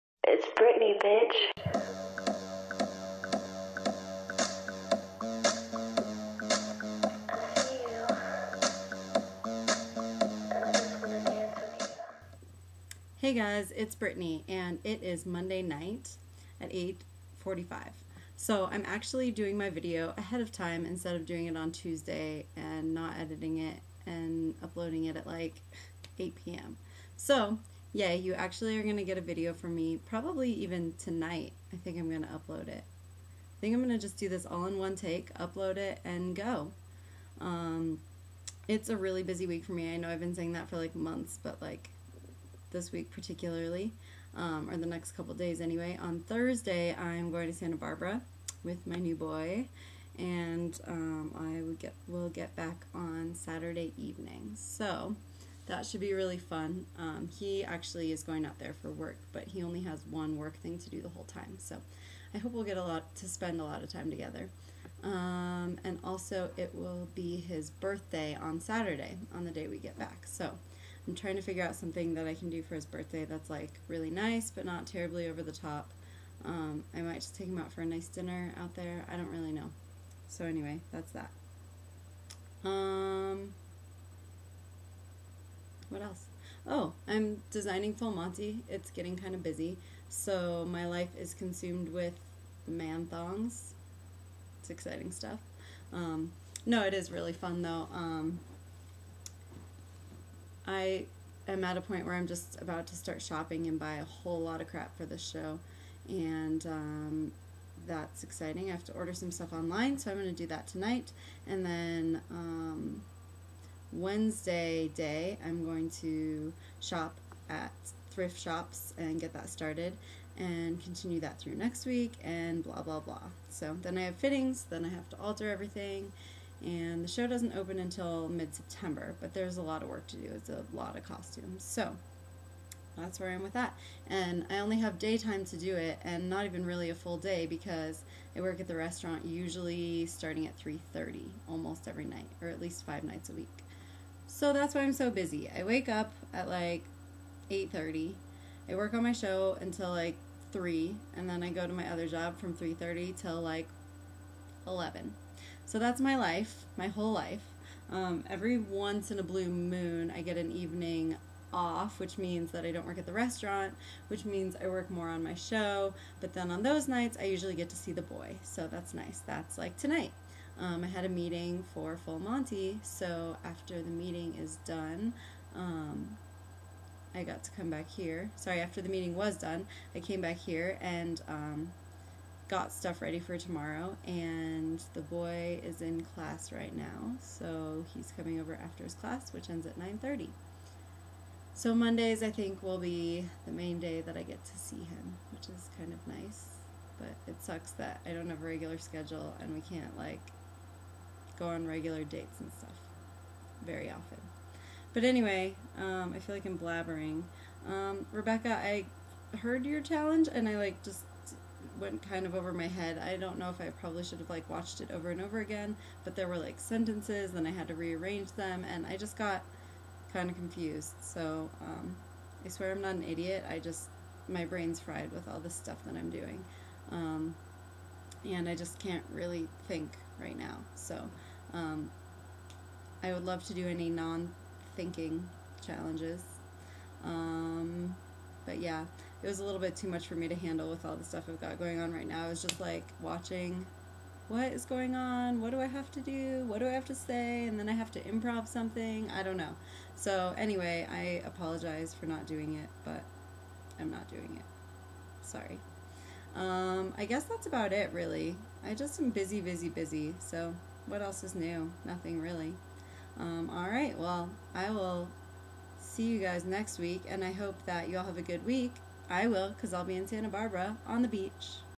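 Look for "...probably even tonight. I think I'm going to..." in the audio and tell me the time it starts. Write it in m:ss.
0:30.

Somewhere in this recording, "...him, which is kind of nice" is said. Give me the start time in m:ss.
3:14.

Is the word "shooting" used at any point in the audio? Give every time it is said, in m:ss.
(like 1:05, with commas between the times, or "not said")
not said.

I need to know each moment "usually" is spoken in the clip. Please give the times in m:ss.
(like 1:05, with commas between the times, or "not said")
2:19, 2:47.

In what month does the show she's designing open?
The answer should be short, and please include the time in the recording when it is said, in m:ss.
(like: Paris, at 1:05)
September, at 2:08.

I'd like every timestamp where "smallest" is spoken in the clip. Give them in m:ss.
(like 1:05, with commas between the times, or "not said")
not said.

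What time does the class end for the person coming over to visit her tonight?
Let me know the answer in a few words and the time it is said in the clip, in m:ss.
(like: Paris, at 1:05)
9:30, at 3:09.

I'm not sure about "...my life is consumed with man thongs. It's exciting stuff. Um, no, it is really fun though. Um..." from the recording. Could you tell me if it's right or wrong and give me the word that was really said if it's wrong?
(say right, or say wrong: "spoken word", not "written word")
right.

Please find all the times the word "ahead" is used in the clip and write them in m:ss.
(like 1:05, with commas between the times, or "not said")
0:20.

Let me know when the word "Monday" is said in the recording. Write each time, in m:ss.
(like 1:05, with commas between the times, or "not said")
0:15, 3:11.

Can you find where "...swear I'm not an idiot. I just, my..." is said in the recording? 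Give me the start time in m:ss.
3:42.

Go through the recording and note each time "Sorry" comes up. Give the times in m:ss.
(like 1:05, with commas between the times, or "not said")
2:58, 4:15.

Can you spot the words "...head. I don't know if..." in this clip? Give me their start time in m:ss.
3:32.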